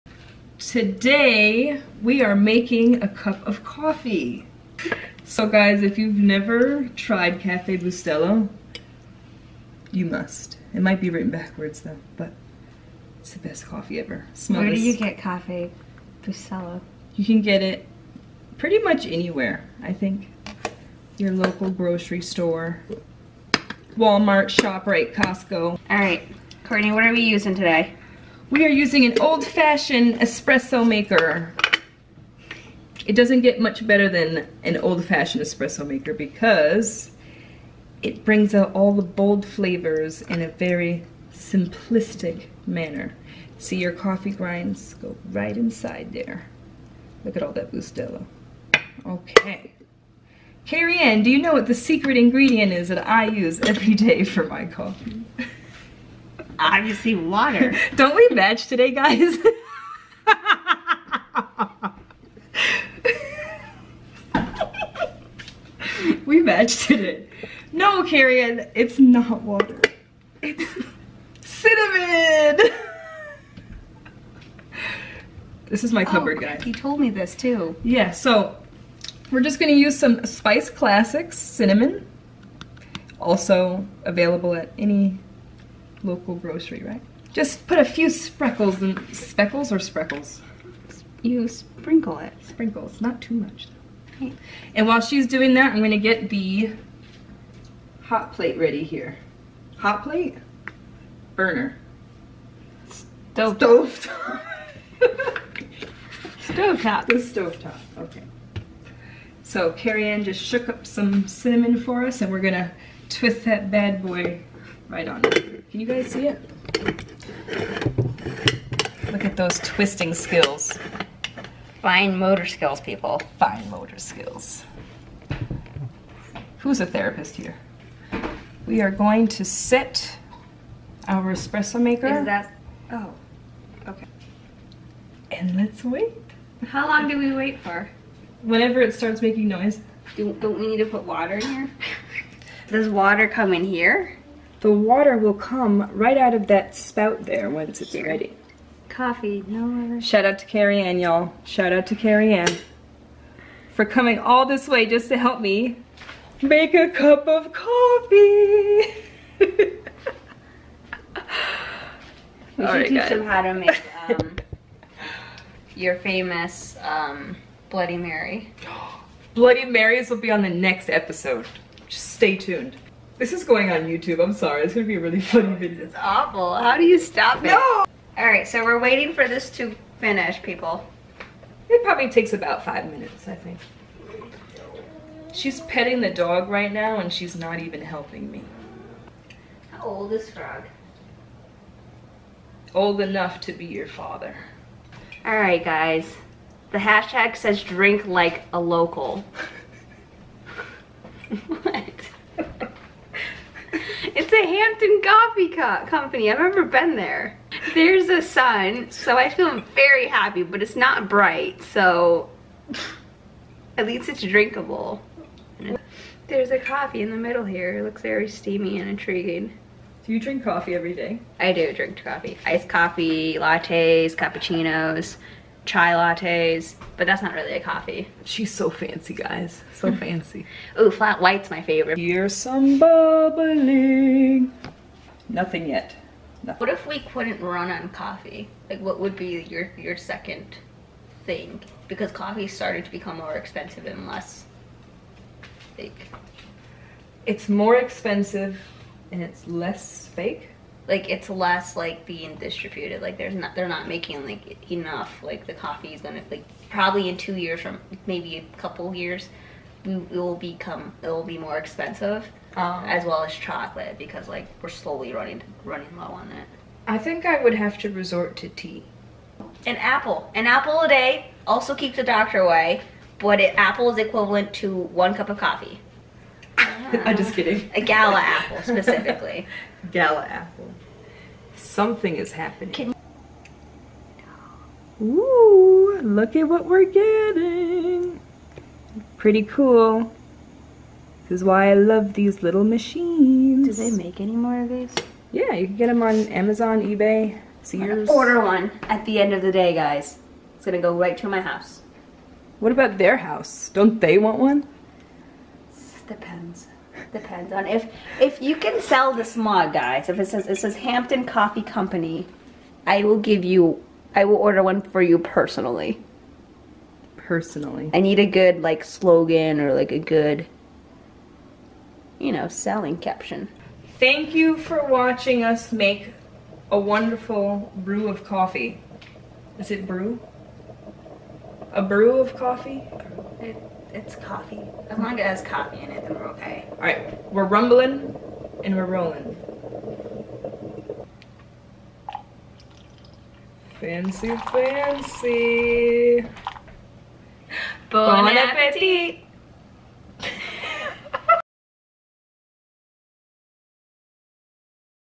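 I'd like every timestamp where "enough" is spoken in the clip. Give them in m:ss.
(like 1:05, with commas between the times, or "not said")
3:13, 4:14.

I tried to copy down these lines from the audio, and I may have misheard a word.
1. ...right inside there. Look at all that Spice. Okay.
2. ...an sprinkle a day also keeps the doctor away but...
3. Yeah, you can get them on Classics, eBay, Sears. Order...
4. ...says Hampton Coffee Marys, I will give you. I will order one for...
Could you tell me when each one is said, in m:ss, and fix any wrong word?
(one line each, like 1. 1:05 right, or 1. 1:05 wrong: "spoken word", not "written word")
1. 0:45 wrong: "Bustelo", not "Spice"
2. 4:30 wrong: "apple", not "sprinkle"
3. 4:55 wrong: "Amazon", not "Classics"
4. 5:10 wrong: "Company", not "Marys".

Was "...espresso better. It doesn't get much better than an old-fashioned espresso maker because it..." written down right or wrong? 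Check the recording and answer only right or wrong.
wrong.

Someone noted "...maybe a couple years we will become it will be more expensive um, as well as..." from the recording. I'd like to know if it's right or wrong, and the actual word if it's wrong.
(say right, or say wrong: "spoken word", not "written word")
right.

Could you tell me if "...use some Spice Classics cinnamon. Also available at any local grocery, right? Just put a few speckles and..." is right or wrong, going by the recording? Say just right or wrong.
right.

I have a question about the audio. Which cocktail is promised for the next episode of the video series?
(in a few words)
Bloody Mary.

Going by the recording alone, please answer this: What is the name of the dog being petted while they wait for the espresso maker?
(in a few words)
Frog.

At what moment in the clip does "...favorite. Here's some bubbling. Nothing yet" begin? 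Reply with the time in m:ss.
3:51.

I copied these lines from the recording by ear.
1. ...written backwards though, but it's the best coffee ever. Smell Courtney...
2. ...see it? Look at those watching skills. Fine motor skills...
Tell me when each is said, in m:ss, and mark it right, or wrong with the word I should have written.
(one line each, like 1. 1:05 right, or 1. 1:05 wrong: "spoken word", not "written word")
1. 0:11 wrong: "Where", not "Courtney"
2. 1:56 wrong: "twisting", not "watching".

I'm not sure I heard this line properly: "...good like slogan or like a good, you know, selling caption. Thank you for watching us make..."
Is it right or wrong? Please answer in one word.
right.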